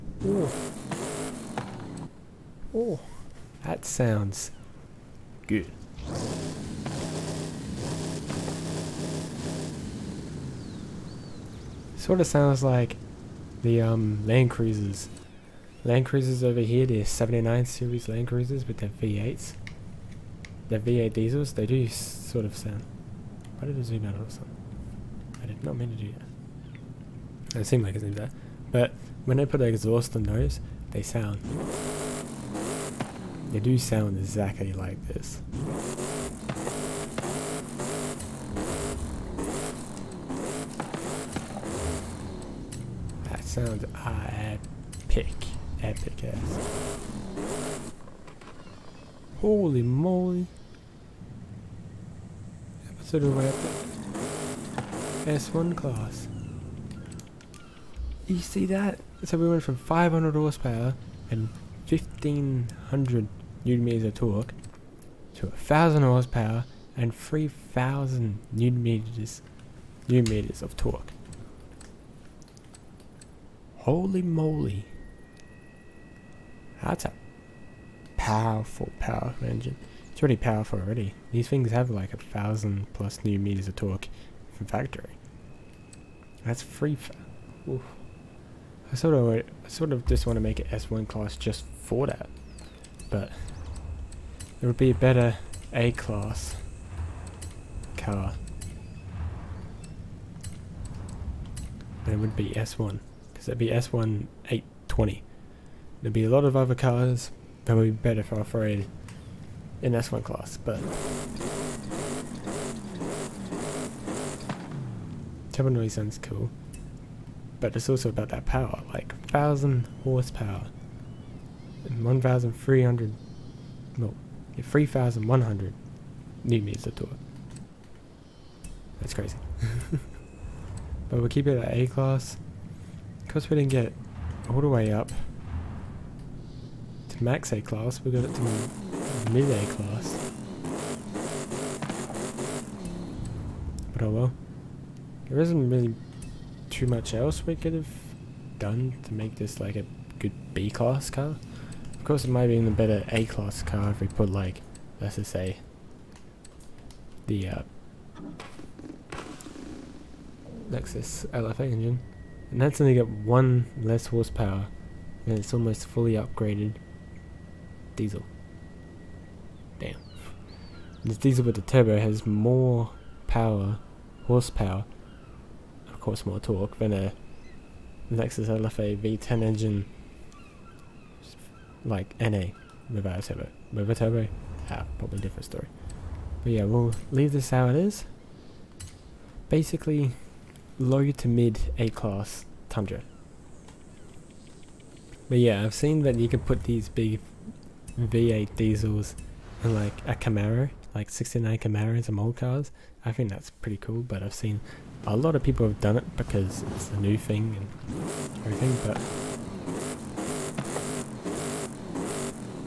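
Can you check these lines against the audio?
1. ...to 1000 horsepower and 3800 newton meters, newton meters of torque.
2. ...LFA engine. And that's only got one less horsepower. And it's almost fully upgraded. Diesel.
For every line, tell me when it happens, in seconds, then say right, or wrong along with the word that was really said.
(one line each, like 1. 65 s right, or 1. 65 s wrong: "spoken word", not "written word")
1. 65 s wrong: "3000", not "3800"
2. 161 s right.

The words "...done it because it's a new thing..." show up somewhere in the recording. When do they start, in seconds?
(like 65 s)
205 s.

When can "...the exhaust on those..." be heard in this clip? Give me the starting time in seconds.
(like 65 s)
29 s.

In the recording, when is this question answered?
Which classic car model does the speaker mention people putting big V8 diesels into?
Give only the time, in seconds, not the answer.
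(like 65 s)
201 s.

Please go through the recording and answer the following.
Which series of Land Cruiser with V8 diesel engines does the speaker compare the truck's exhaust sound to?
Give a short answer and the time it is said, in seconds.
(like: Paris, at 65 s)
79 series, at 17 s.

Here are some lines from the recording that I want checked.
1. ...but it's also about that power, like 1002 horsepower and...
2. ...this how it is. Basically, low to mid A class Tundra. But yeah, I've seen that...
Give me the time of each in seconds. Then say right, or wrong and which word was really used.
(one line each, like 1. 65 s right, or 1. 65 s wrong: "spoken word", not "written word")
1. 117 s wrong: "1000", not "1002"
2. 187 s right.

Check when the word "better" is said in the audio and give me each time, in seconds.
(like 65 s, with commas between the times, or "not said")
94 s, 107 s, 152 s.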